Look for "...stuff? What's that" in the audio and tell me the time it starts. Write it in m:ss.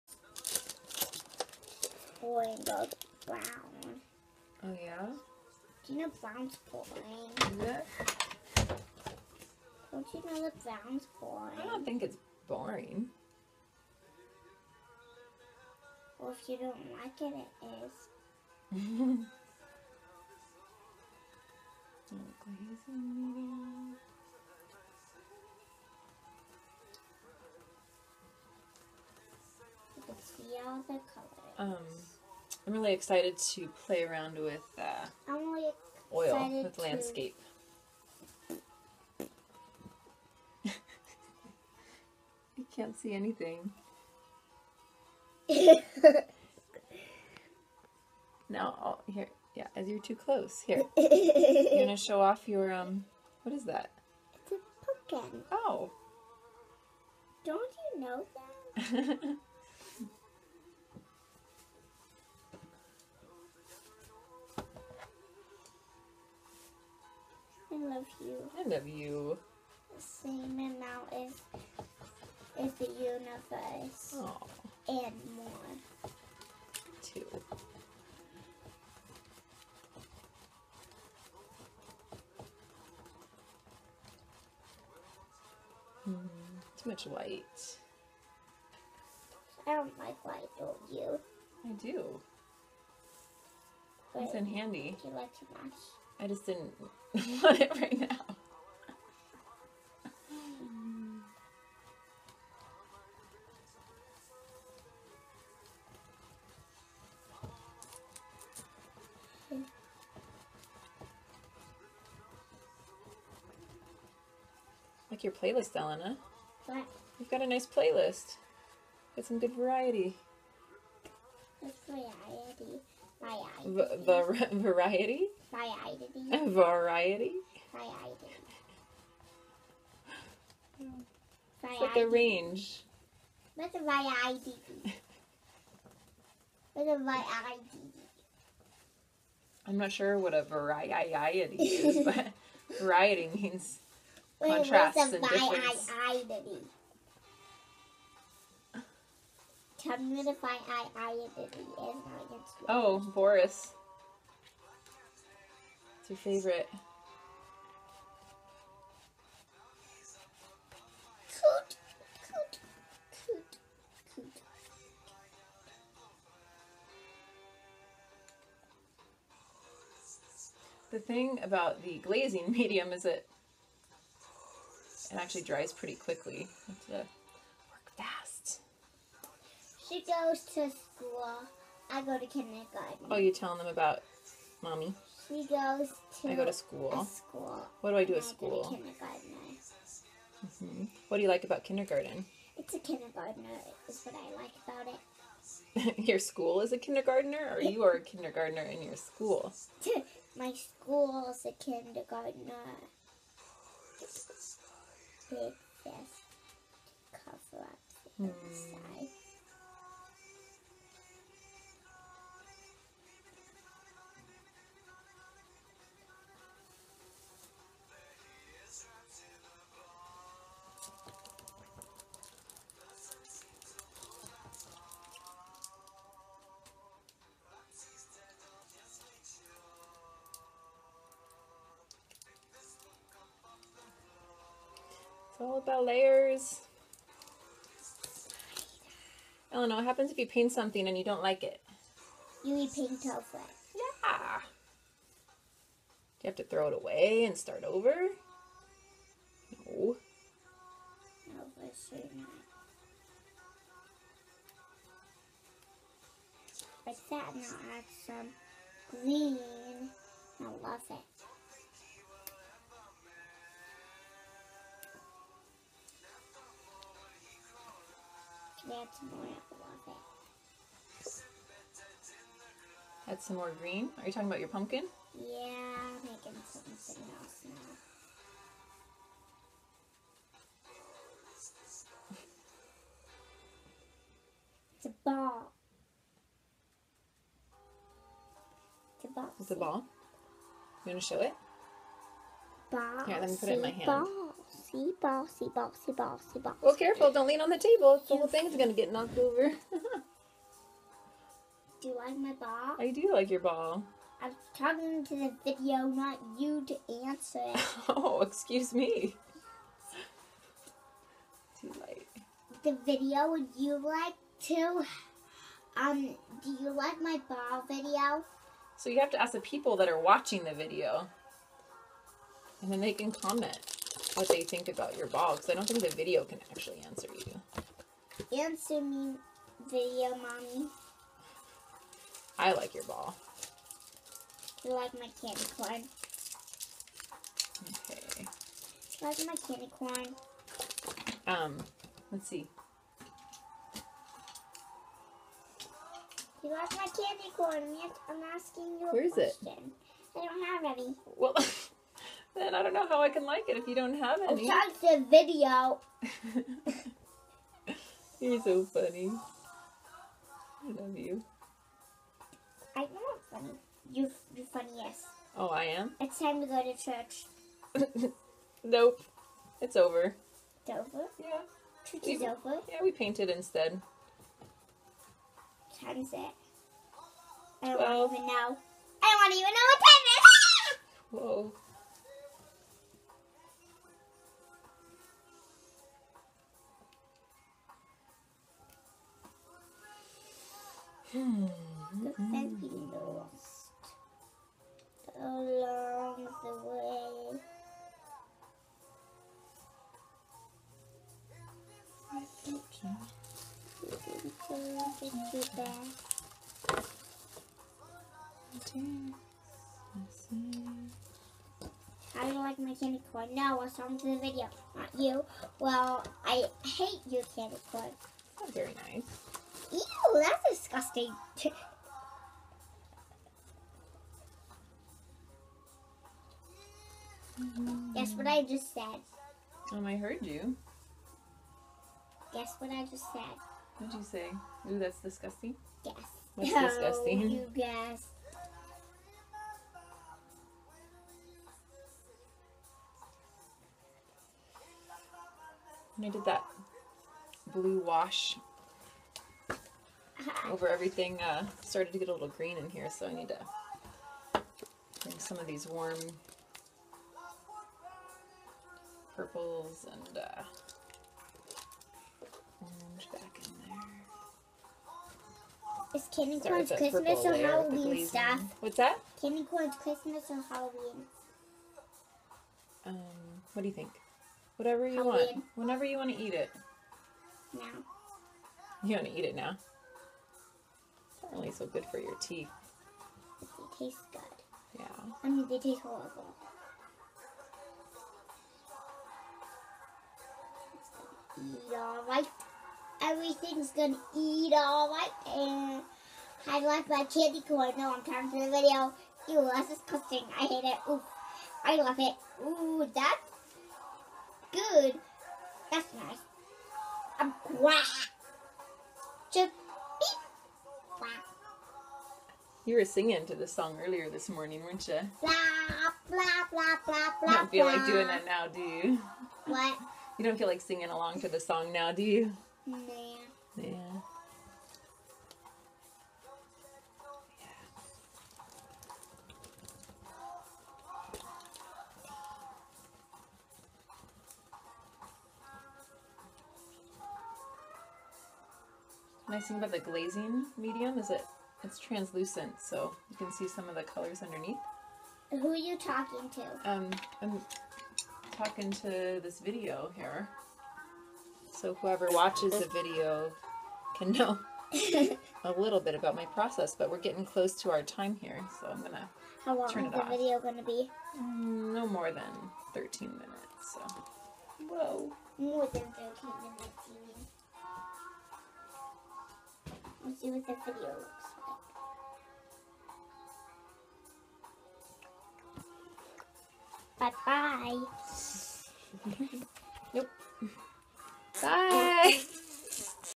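7:48.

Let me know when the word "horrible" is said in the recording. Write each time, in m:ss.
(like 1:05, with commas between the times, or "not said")
8:05.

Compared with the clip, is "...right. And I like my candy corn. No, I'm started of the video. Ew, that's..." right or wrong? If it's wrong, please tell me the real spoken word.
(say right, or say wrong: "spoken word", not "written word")
wrong: "tired", not "started".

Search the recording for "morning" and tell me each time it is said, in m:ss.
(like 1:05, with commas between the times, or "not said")
8:34.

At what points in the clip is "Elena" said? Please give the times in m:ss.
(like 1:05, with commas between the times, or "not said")
1:55, 3:59.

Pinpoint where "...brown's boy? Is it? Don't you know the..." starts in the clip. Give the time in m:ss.
0:06.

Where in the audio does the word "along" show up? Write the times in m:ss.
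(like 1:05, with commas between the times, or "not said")
6:35, 8:40.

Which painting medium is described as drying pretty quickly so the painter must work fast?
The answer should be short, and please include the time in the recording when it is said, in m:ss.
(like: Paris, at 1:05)
glazing medium, at 2:51.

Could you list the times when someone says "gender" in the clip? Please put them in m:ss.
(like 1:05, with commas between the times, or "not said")
not said.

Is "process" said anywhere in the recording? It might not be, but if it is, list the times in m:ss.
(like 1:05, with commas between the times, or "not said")
9:16.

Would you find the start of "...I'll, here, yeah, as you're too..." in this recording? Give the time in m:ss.
0:48.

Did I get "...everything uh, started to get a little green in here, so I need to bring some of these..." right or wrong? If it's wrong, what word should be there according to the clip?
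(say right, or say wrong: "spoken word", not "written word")
right.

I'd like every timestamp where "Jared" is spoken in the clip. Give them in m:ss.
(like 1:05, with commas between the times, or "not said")
not said.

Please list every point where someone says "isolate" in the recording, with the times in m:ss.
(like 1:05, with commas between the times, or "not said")
not said.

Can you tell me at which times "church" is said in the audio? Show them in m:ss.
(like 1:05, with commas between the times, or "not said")
6:06, 6:11.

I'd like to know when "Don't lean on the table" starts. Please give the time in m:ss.
4:57.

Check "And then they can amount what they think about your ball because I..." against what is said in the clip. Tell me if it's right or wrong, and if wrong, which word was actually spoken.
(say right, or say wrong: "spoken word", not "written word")
wrong: "comment", not "amount".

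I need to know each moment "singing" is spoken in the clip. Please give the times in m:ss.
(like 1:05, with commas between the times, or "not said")
8:32, 8:40.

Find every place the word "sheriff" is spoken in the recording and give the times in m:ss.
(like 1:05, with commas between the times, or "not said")
not said.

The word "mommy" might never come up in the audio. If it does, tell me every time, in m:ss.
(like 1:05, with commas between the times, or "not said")
3:04, 5:30.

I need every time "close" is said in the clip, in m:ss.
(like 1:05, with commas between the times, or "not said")
0:50, 9:17.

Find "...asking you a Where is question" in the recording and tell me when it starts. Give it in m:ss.
5:48.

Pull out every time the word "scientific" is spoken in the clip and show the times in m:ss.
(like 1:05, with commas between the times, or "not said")
not said.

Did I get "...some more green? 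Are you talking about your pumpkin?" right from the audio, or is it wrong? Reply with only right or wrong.
right.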